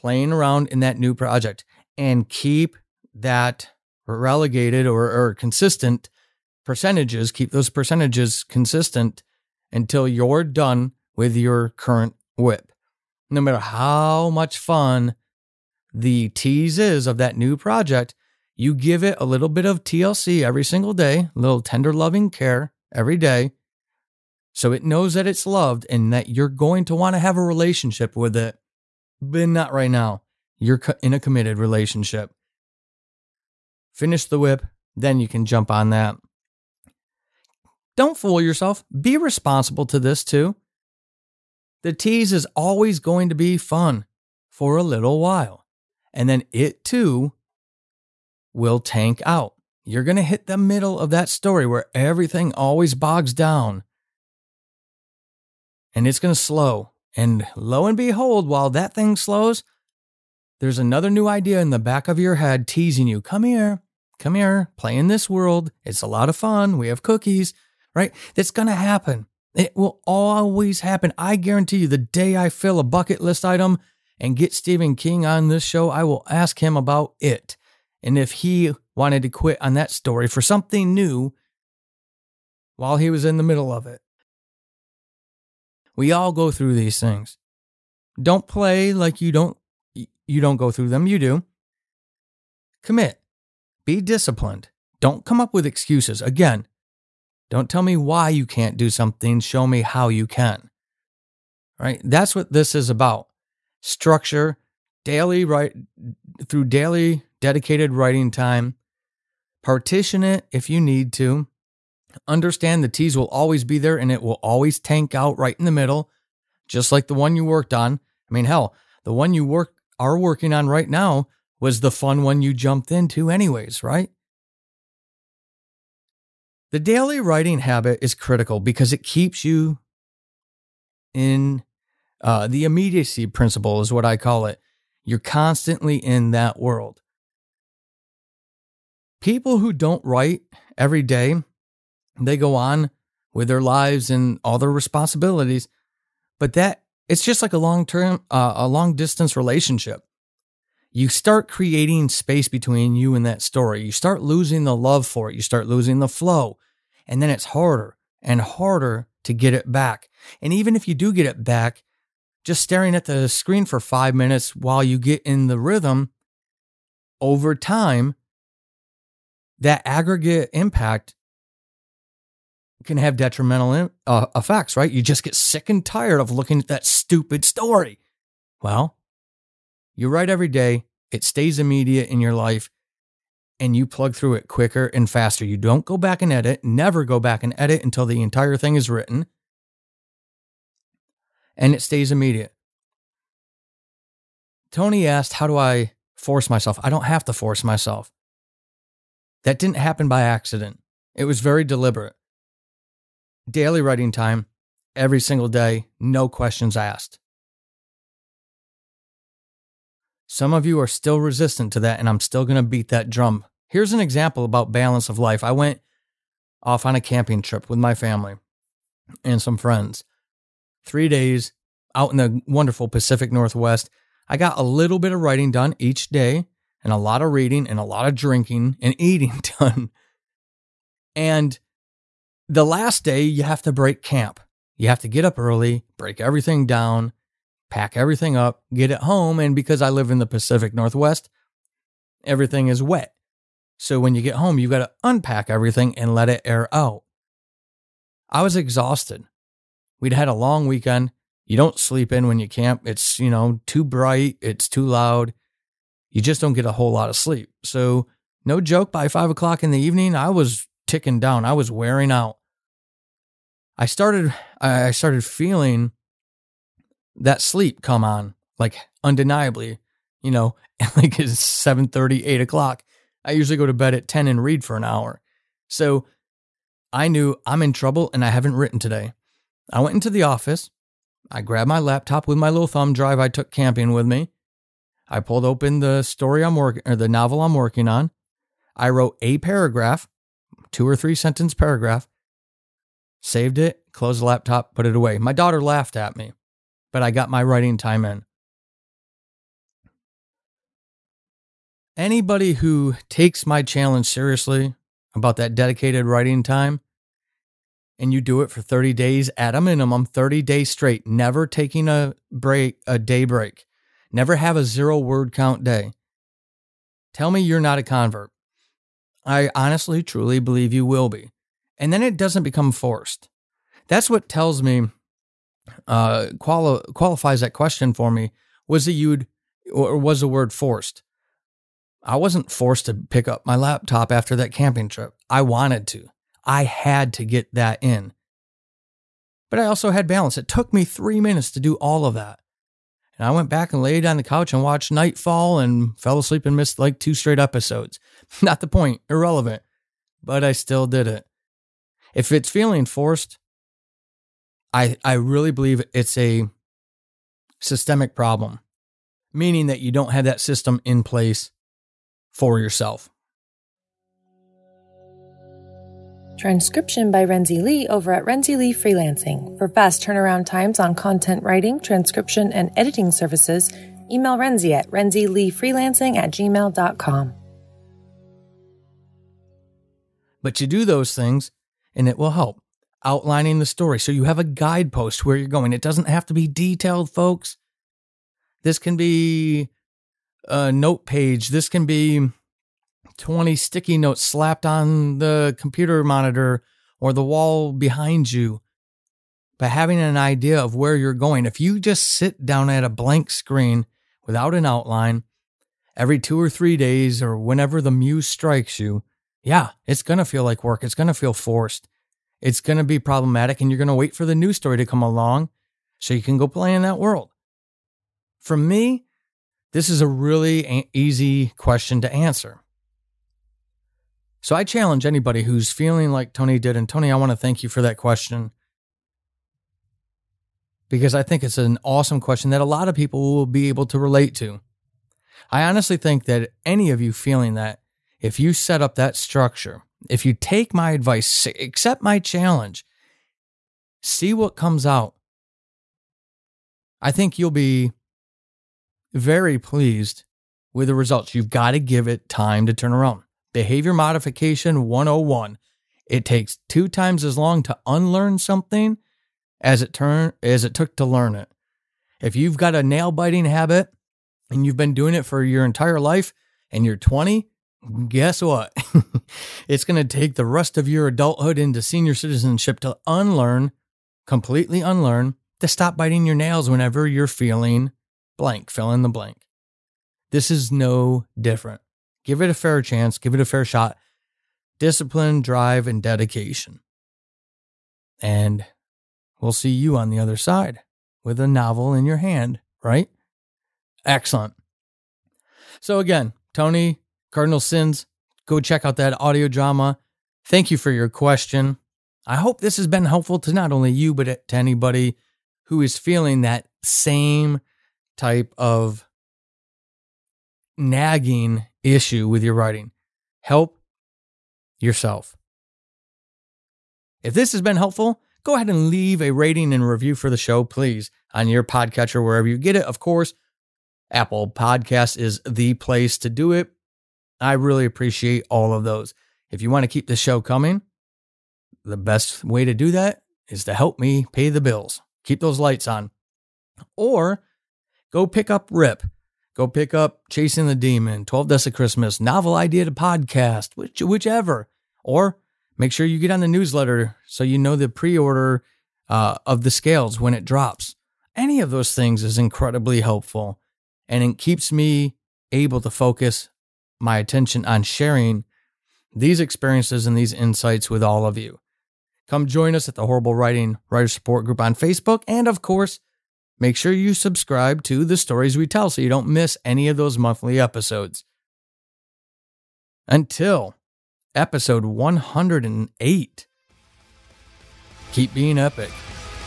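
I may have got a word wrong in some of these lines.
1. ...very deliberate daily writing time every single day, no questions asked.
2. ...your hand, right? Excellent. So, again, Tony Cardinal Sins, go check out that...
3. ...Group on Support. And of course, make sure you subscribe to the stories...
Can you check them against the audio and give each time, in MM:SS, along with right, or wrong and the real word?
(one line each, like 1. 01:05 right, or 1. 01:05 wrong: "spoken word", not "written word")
1. 03:21 right
2. 08:12 right
3. 09:24 wrong: "Facebook", not "Support".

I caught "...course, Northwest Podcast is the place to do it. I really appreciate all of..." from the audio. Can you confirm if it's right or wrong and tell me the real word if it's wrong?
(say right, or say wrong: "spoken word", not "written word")
wrong: "Apple", not "Northwest".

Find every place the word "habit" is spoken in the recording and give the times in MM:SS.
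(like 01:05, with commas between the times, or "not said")
02:07, 07:43.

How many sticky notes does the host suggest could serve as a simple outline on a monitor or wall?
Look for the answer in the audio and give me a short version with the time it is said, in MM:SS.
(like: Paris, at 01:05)
20, at 06:33.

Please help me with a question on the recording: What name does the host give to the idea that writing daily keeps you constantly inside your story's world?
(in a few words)
the immediacy principle.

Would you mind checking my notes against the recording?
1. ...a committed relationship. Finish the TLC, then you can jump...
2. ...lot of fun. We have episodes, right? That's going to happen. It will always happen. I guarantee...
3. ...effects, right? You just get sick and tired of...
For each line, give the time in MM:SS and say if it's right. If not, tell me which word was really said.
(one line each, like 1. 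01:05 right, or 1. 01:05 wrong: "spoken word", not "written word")
1. 00:31 wrong: "WIP", not "TLC"
2. 01:06 wrong: "cookies", not "episodes"
3. 02:54 right.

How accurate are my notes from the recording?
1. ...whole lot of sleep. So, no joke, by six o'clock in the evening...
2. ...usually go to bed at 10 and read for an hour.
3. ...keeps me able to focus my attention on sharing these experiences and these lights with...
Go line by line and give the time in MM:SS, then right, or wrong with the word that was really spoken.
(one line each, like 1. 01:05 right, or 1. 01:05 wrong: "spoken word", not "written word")
1. 04:16 wrong: "five", not "six"
2. 04:33 right
3. 09:14 wrong: "insights", not "lights".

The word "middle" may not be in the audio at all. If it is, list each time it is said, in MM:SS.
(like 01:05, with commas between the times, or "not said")
00:50, 01:23, 01:55.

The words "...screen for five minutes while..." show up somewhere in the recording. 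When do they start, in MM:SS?
02:43.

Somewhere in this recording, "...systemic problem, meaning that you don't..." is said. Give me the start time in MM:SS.
05:57.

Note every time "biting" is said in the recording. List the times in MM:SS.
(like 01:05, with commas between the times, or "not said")
07:43, 07:55.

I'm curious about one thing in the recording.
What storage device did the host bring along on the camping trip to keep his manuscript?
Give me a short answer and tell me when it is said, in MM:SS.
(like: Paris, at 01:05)
thumb drive, at 04:42.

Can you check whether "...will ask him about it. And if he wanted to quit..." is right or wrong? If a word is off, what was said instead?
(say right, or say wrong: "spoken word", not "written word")
right.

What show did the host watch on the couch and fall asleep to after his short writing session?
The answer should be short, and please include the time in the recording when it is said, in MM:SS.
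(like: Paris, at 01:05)
Nightfall, at 05:44.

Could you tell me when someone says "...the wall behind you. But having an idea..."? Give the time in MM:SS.
06:37.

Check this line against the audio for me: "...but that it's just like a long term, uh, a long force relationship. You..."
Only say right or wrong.
wrong.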